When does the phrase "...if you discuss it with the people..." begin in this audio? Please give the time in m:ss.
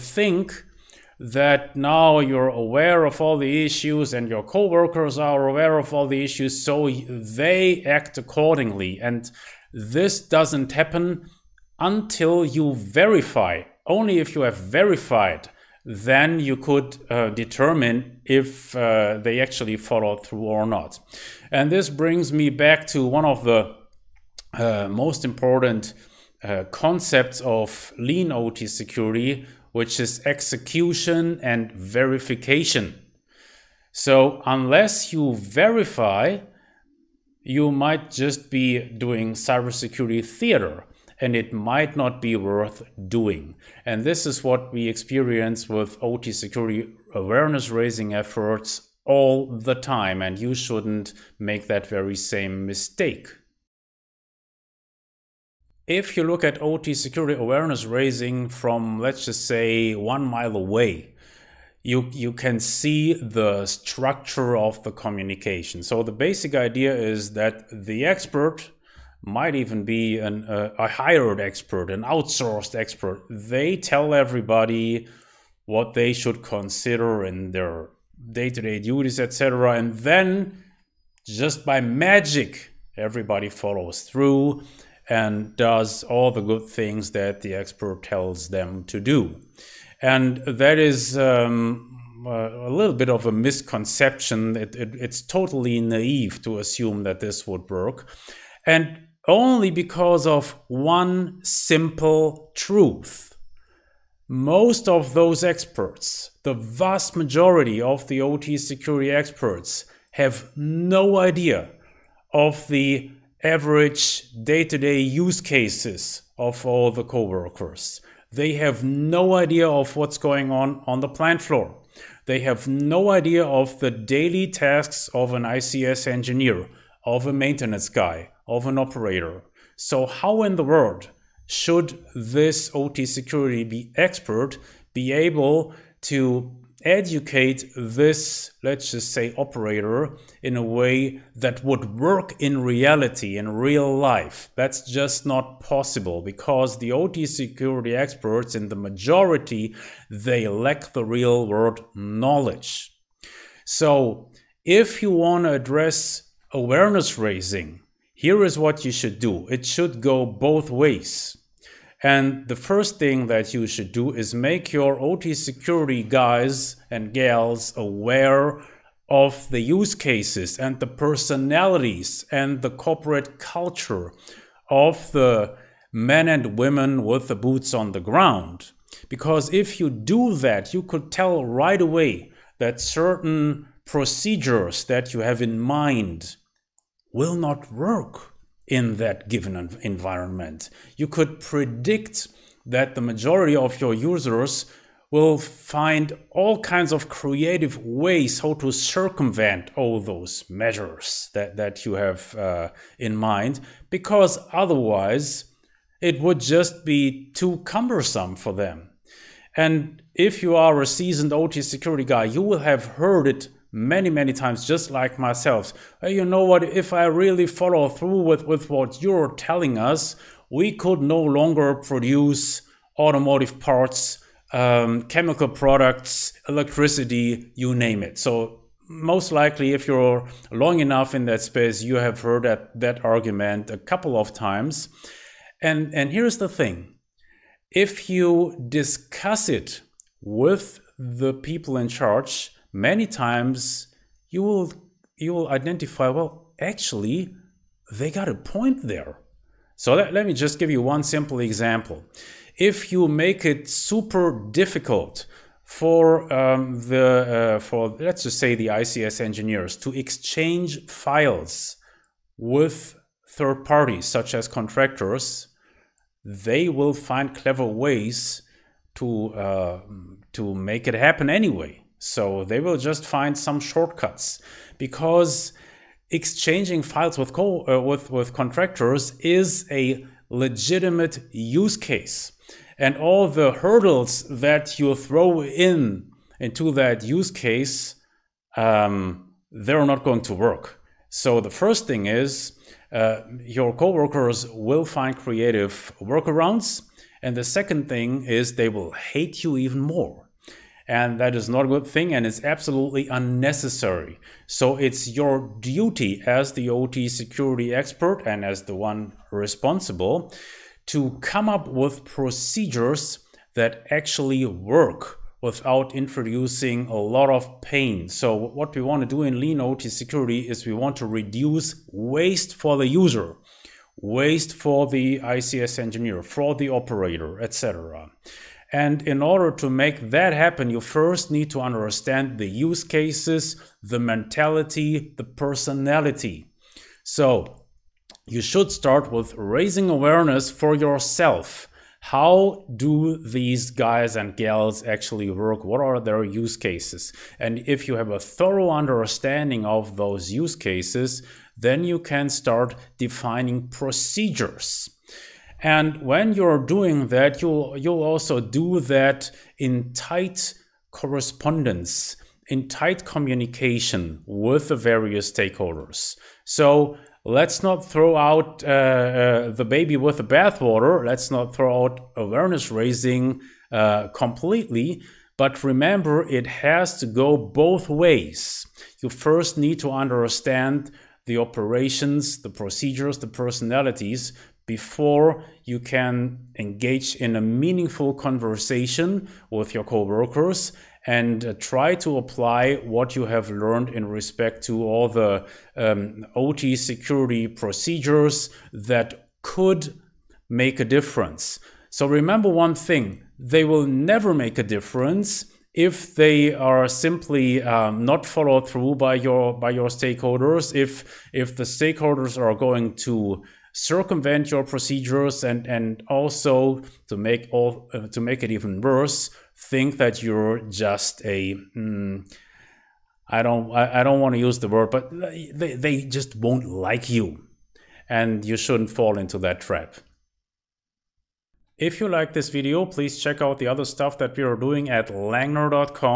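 3:57.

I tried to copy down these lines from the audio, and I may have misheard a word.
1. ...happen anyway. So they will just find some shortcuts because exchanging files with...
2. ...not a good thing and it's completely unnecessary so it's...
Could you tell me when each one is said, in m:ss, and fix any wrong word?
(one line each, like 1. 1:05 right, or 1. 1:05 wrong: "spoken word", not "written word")
1. 4:30 right
2. 5:01 wrong: "absolutely", not "completely".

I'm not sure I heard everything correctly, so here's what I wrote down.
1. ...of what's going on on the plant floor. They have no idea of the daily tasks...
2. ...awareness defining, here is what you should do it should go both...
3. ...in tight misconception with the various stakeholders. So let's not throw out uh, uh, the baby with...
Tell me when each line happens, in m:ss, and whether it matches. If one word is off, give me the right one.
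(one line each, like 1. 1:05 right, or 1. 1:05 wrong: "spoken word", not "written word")
1. 1:59 right
2. 2:36 wrong: "raising", not "defining"
3. 6:02 wrong: "communication", not "misconception".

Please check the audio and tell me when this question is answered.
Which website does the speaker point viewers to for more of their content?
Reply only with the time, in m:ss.
7:15.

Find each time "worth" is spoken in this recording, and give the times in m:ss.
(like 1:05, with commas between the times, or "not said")
0:42.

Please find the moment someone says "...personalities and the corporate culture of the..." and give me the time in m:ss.
2:50.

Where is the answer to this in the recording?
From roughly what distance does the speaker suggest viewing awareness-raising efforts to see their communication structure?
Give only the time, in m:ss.
0:59.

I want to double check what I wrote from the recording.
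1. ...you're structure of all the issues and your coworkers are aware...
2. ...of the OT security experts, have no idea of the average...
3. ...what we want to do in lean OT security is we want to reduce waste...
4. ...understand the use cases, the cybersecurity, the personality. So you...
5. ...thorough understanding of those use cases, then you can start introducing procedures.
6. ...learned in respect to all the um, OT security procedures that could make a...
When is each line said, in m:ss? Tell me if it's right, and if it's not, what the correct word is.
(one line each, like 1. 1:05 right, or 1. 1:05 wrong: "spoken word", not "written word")
1. 0:02 wrong: "aware", not "structure"
2. 1:47 right
3. 5:18 right
4. 5:31 wrong: "mentality", not "cybersecurity"
5. 5:48 wrong: "defining", not "introducing"
6. 6:33 right.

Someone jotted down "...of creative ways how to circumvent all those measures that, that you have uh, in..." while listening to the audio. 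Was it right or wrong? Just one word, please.
right.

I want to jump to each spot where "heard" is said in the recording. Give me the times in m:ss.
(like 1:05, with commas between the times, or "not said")
3:32, 3:52.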